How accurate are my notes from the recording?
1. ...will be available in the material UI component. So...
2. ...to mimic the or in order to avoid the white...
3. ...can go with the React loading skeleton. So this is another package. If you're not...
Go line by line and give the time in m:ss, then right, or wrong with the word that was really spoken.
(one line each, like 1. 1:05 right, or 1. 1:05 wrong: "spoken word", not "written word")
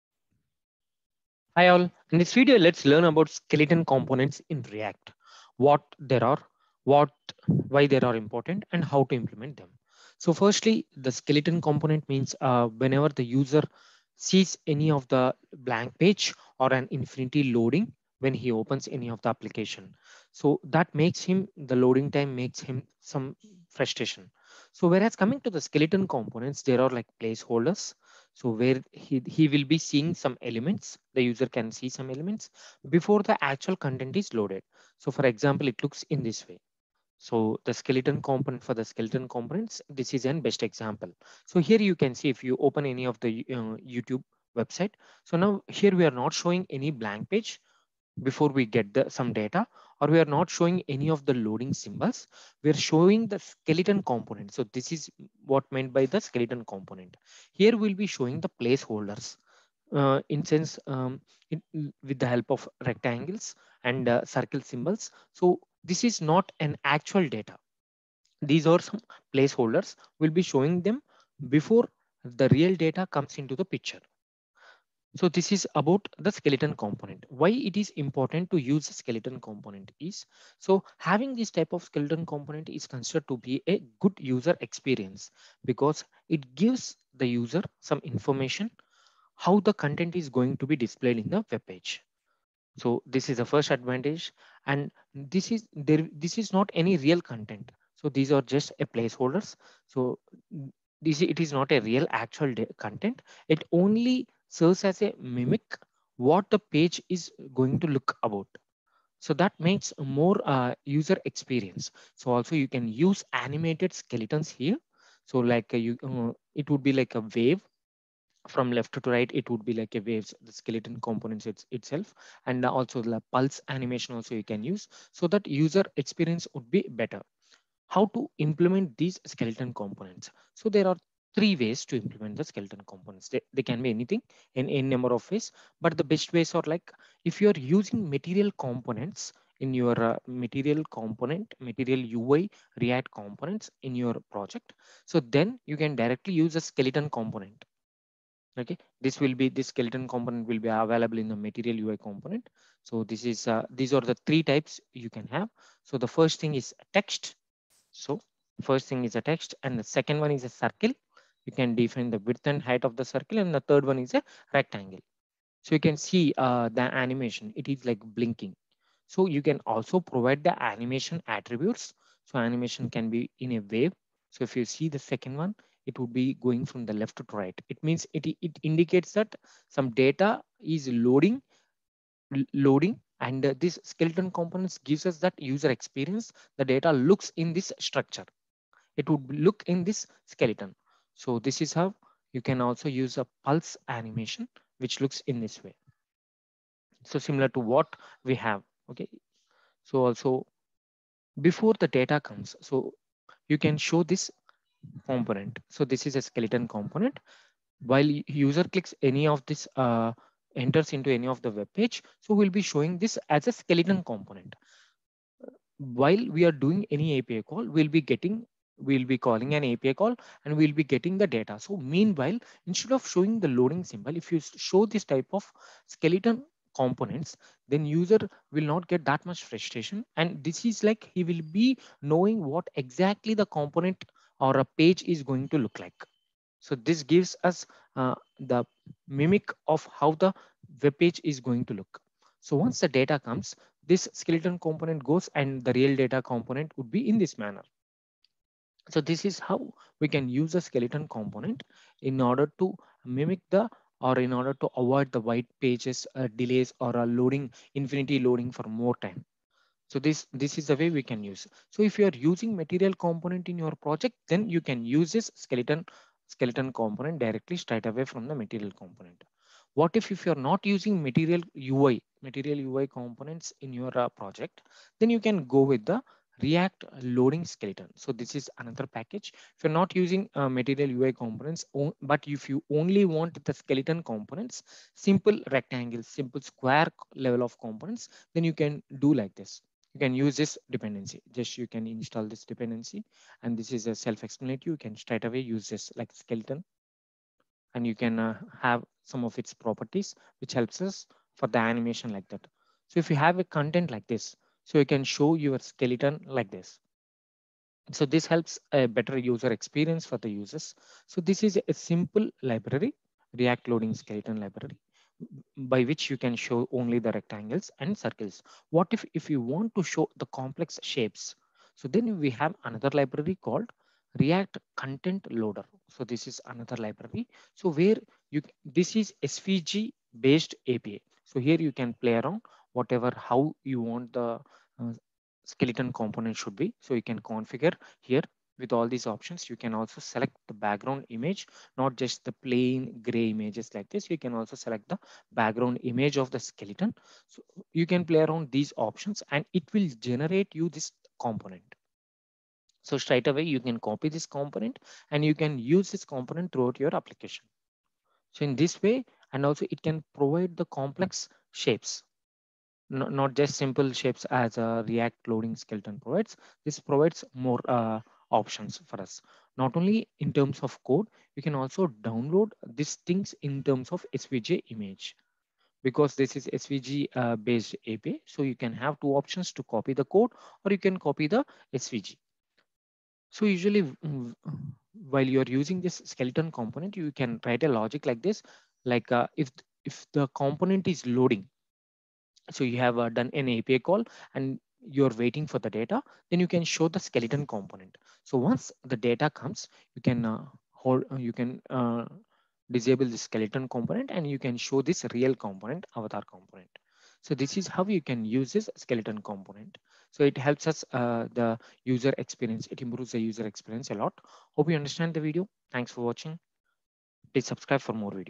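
1. 2:30 right
2. 4:12 right
3. 4:35 right.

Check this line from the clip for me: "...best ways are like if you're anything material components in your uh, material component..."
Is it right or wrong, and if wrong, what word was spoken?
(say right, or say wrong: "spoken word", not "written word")
wrong: "using", not "anything".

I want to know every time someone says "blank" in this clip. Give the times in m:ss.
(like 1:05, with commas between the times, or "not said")
0:15, 0:46.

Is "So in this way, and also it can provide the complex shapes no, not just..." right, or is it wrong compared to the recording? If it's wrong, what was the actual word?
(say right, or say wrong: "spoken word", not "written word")
right.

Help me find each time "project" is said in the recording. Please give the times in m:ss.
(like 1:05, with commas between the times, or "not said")
2:24, 4:23, 4:34.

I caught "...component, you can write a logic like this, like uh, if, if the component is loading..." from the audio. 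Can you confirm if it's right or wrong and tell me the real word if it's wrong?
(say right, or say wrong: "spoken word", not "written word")
right.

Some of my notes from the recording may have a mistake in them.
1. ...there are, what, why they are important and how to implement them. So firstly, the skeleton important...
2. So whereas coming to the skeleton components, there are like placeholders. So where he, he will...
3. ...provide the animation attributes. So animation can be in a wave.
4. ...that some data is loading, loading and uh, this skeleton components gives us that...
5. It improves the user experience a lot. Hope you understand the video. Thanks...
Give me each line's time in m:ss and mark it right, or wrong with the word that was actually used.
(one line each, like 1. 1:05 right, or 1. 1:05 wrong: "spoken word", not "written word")
1. 0:05 wrong: "component", not "important"
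2. 0:24 right
3. 2:49 right
4. 2:59 right
5. 6:52 right.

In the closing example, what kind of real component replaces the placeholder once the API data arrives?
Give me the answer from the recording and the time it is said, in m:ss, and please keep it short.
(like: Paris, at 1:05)
avatar component, at 6:45.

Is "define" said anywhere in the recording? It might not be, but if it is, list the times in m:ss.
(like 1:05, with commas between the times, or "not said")
2:41.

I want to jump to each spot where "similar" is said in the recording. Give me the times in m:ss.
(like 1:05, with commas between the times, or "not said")
3:17.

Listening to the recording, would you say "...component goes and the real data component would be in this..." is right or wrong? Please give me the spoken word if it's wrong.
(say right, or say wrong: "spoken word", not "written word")
right.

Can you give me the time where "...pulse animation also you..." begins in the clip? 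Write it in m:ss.
2:03.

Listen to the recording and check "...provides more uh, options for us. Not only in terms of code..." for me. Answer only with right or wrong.
right.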